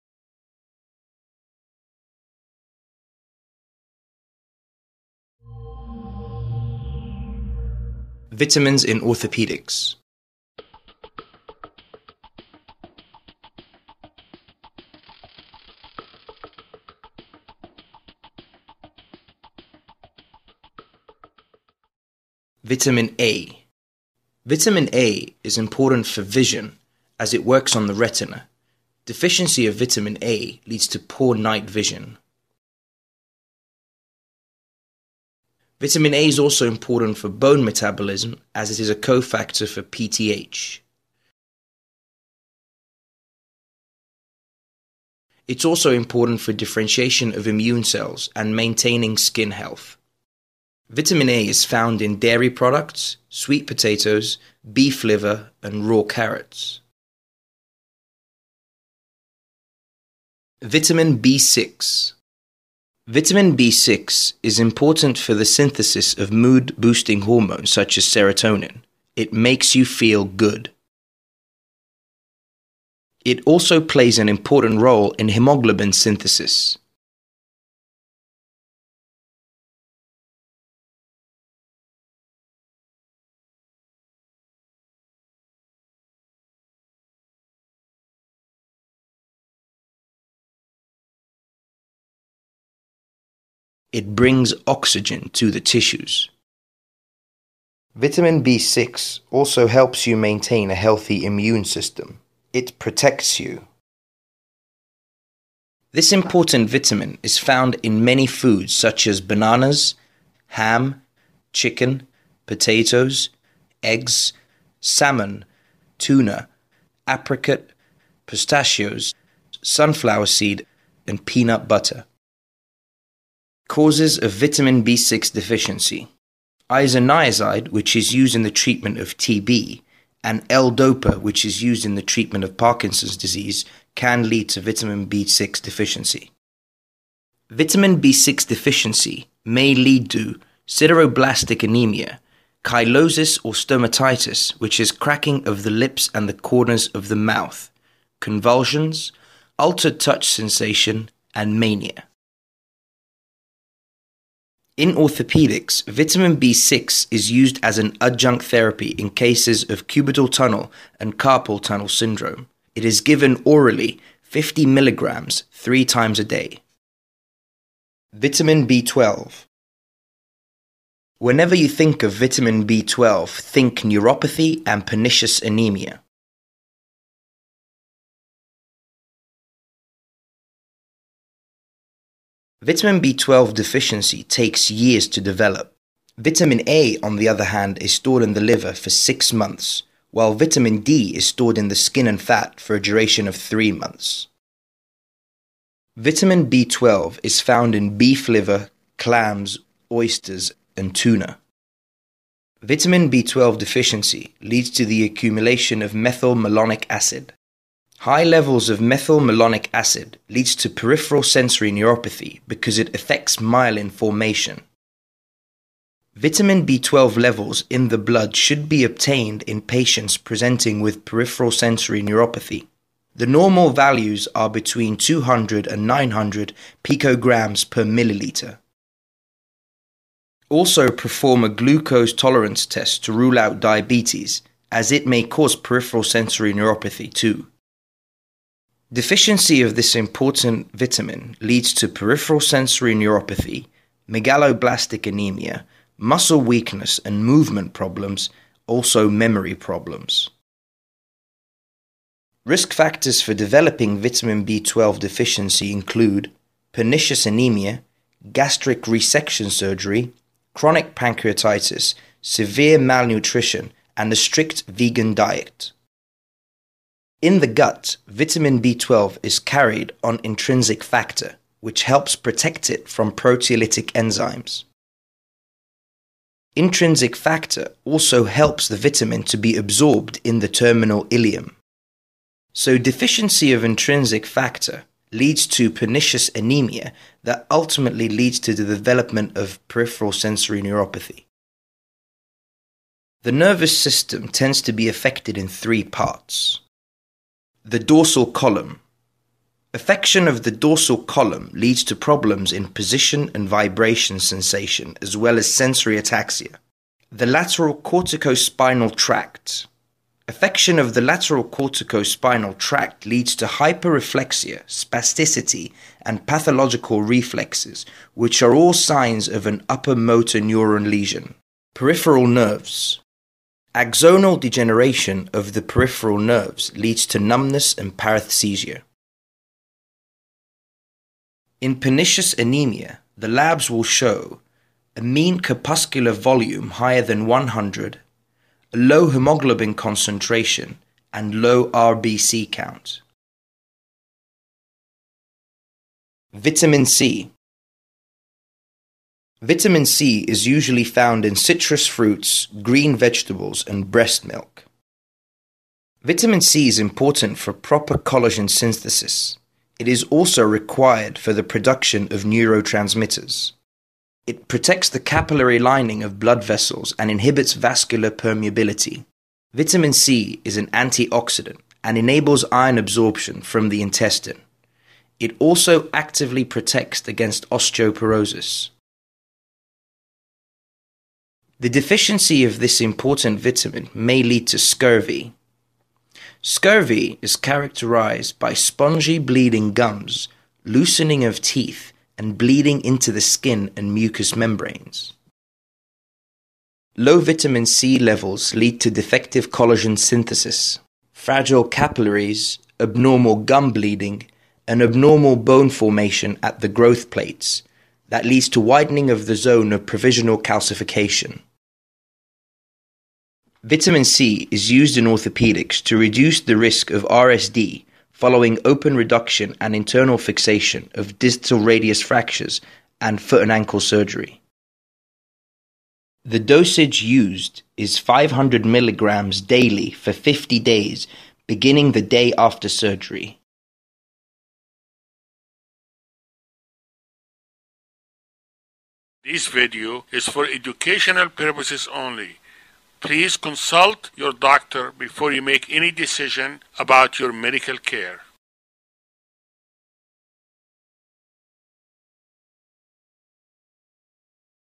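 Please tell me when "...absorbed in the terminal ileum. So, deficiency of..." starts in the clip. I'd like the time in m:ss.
4:39.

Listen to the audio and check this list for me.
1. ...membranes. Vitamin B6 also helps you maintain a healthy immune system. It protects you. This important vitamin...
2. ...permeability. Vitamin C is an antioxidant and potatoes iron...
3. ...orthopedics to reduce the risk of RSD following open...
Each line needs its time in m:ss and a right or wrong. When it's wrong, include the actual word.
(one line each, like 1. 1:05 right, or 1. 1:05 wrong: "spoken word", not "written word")
1. 1:35 wrong: "tissues", not "membranes"
2. 6:08 wrong: "enables", not "potatoes"
3. 6:55 right.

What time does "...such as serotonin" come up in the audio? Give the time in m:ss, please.
1:07.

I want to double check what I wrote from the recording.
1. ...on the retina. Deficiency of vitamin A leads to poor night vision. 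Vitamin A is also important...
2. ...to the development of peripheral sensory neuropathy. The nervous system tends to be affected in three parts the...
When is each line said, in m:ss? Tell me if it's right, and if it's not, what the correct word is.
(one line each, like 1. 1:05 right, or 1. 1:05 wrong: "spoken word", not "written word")
1. 0:27 right
2. 4:48 right.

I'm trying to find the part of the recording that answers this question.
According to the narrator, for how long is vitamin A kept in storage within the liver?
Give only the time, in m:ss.
3:08.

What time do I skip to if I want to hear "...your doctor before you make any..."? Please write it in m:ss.
7:24.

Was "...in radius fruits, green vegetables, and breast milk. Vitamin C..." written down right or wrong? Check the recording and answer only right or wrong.
wrong.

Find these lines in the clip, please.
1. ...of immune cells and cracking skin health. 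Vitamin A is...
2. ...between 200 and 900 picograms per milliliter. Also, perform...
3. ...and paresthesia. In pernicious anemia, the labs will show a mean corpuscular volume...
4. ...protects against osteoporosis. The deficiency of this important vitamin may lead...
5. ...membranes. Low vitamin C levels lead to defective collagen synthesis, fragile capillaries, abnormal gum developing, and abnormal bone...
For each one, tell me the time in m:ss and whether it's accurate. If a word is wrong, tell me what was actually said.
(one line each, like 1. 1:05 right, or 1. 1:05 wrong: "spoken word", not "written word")
1. 0:47 wrong: "maintaining", not "cracking"
2. 3:44 right
3. 5:27 right
4. 6:16 right
5. 6:34 wrong: "bleeding", not "developing".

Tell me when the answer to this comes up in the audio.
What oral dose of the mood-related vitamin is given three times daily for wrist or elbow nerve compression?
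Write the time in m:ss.
2:44.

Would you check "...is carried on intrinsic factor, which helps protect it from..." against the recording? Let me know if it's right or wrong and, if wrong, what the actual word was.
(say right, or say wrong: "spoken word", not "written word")
right.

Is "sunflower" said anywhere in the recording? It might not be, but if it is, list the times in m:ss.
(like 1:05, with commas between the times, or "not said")
1:59.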